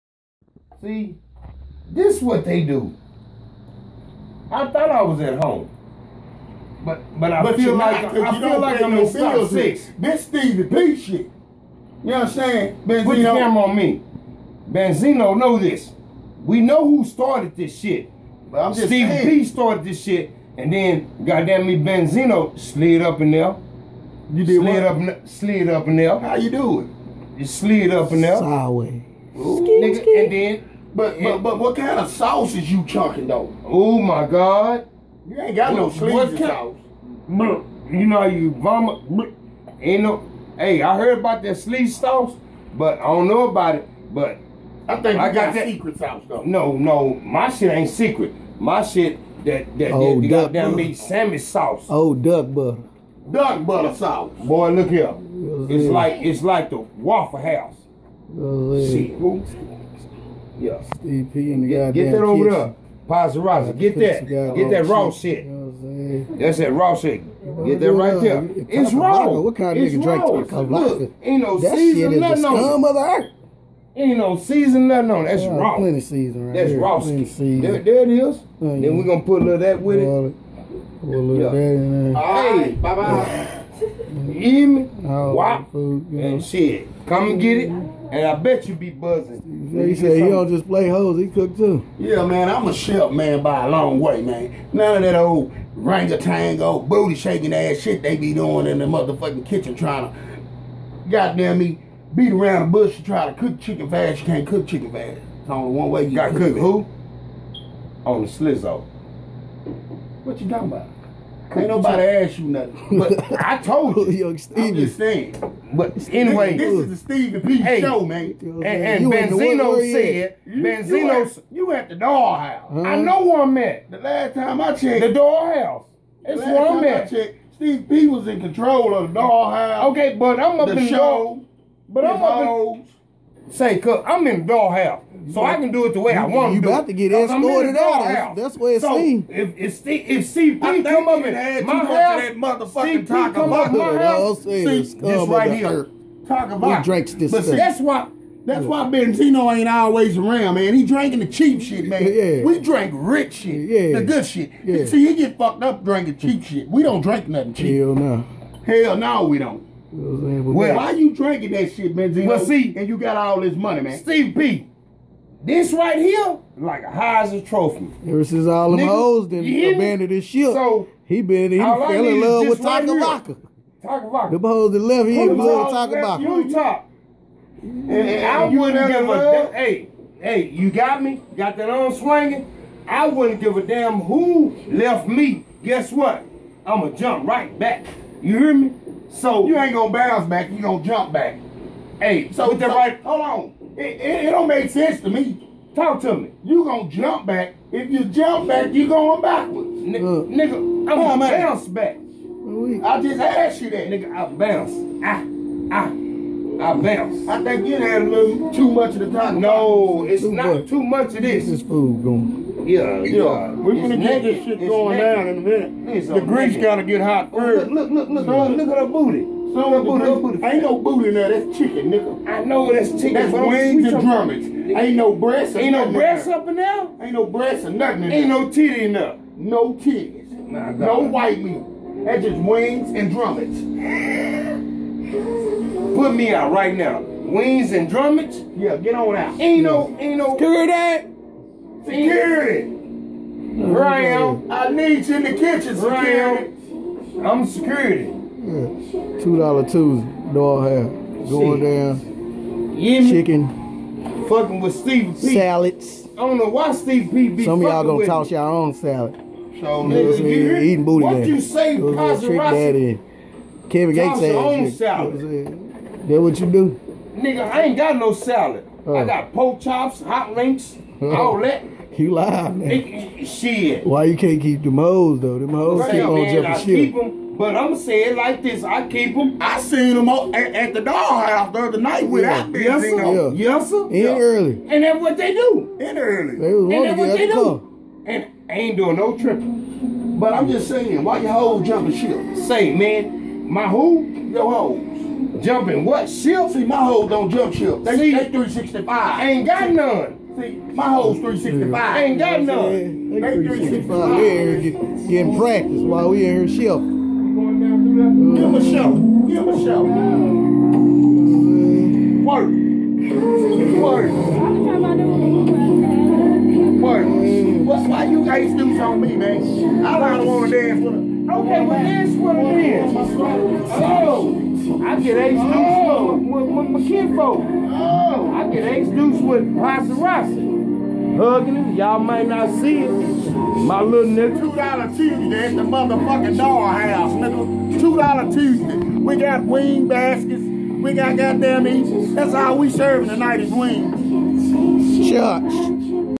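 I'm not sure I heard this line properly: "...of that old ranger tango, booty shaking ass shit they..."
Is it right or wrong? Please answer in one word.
right.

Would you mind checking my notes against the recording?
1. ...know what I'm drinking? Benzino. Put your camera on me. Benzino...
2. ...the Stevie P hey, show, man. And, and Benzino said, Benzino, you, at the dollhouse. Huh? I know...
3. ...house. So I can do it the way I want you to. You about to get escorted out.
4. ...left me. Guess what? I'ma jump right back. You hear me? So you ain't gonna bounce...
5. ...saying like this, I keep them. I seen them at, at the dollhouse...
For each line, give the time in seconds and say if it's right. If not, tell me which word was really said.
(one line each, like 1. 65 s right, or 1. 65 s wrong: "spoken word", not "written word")
1. 12 s wrong: "saying", not "drinking"
2. 116 s right
3. 134 s right
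4. 184 s right
5. 277 s right.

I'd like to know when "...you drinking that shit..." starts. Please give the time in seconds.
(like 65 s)
160 s.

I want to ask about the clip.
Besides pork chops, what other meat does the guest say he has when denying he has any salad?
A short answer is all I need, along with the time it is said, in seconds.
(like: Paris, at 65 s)
Hot links, at 270 s.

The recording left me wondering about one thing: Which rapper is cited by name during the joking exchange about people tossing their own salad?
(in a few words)
Kevin Gates.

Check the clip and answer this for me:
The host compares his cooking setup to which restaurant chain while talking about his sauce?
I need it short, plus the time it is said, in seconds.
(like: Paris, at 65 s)
Waffle House, at 56 s.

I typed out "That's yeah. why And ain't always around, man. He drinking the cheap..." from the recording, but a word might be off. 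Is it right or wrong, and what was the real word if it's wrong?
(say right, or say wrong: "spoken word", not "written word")
wrong: "Benzino", not "And".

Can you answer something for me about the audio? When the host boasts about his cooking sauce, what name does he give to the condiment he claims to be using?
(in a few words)
Duck butter sauce.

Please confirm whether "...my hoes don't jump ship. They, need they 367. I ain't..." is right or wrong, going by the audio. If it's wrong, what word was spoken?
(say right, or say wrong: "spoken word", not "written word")
wrong: "365", not "367".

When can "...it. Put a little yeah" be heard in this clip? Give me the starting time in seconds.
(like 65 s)
79 s.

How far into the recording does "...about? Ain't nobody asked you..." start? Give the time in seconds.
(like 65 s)
110 s.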